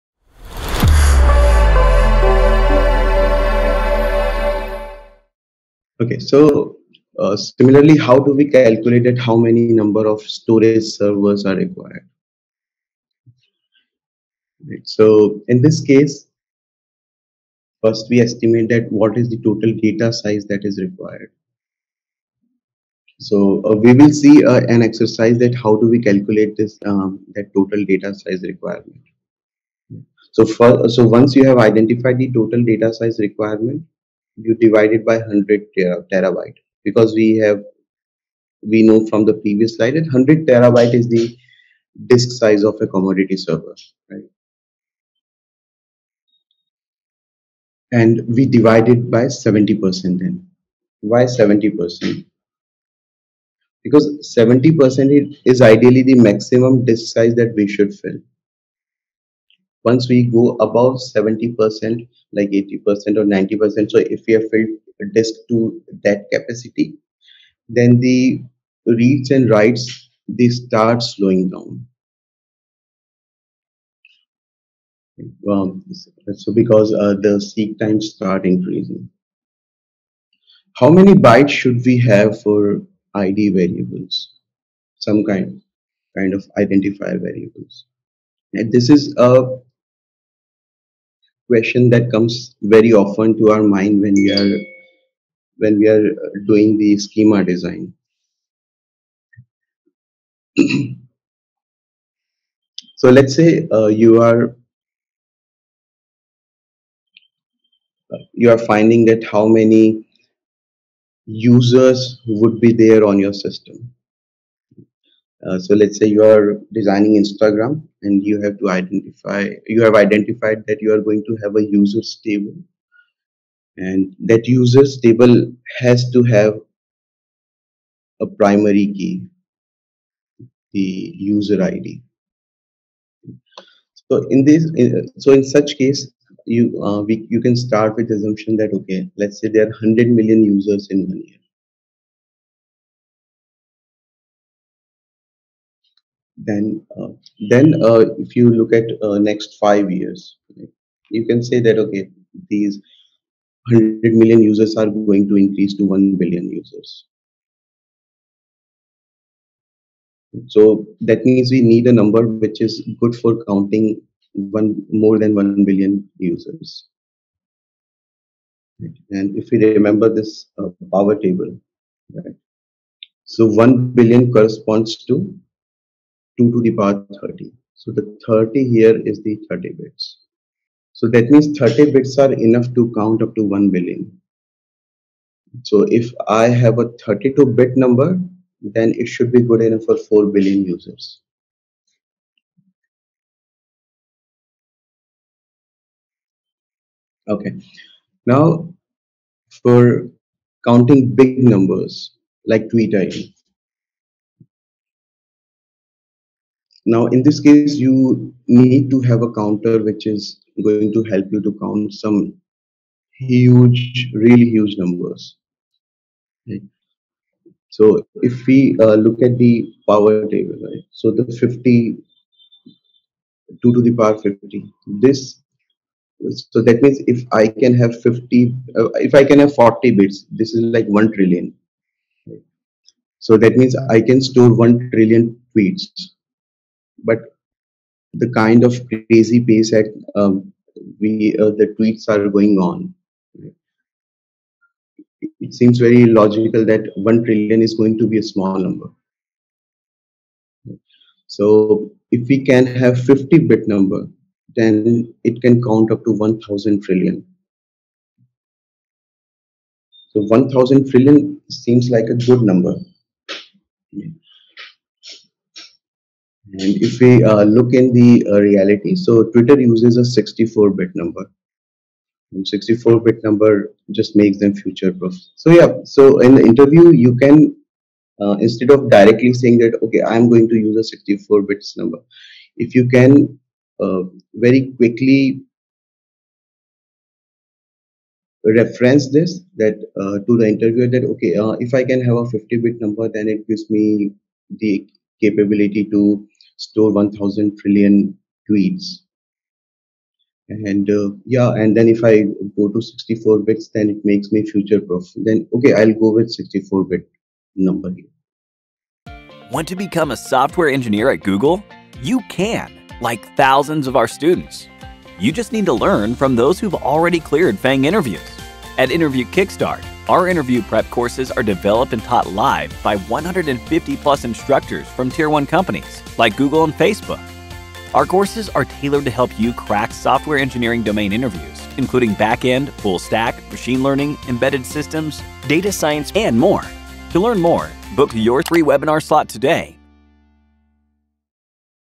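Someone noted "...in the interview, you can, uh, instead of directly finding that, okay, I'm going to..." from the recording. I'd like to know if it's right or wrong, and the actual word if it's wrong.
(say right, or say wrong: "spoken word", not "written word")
wrong: "saying", not "finding".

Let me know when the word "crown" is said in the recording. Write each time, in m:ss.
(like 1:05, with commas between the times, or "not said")
not said.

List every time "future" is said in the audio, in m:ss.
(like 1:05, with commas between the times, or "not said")
4:34, 5:04.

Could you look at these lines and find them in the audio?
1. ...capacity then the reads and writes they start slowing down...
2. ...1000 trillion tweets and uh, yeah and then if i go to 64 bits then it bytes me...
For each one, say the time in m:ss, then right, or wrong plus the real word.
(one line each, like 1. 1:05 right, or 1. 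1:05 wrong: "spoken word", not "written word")
1. 1:06 right
2. 4:56 wrong: "makes", not "bytes".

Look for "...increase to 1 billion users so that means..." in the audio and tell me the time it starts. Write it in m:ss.
2:35.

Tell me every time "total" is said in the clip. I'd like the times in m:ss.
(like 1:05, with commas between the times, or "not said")
0:19, 0:27, 0:32.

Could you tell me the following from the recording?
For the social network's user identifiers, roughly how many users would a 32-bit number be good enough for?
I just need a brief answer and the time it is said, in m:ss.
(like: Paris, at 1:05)
4 billion, at 3:09.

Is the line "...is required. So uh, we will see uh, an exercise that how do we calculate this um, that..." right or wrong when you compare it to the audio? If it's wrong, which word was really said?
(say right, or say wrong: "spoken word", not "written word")
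right.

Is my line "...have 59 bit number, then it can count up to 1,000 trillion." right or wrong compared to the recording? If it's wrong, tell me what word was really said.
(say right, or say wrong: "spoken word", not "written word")
wrong: "50", not "59".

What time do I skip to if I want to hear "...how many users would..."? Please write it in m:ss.
1:49.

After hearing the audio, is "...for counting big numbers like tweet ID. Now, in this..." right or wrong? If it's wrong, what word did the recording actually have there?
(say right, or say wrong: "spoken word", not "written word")
right.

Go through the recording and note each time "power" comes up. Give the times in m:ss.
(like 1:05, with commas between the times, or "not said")
2:50, 2:56, 3:39, 3:43.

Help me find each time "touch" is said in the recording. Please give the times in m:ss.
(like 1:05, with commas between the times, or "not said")
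not said.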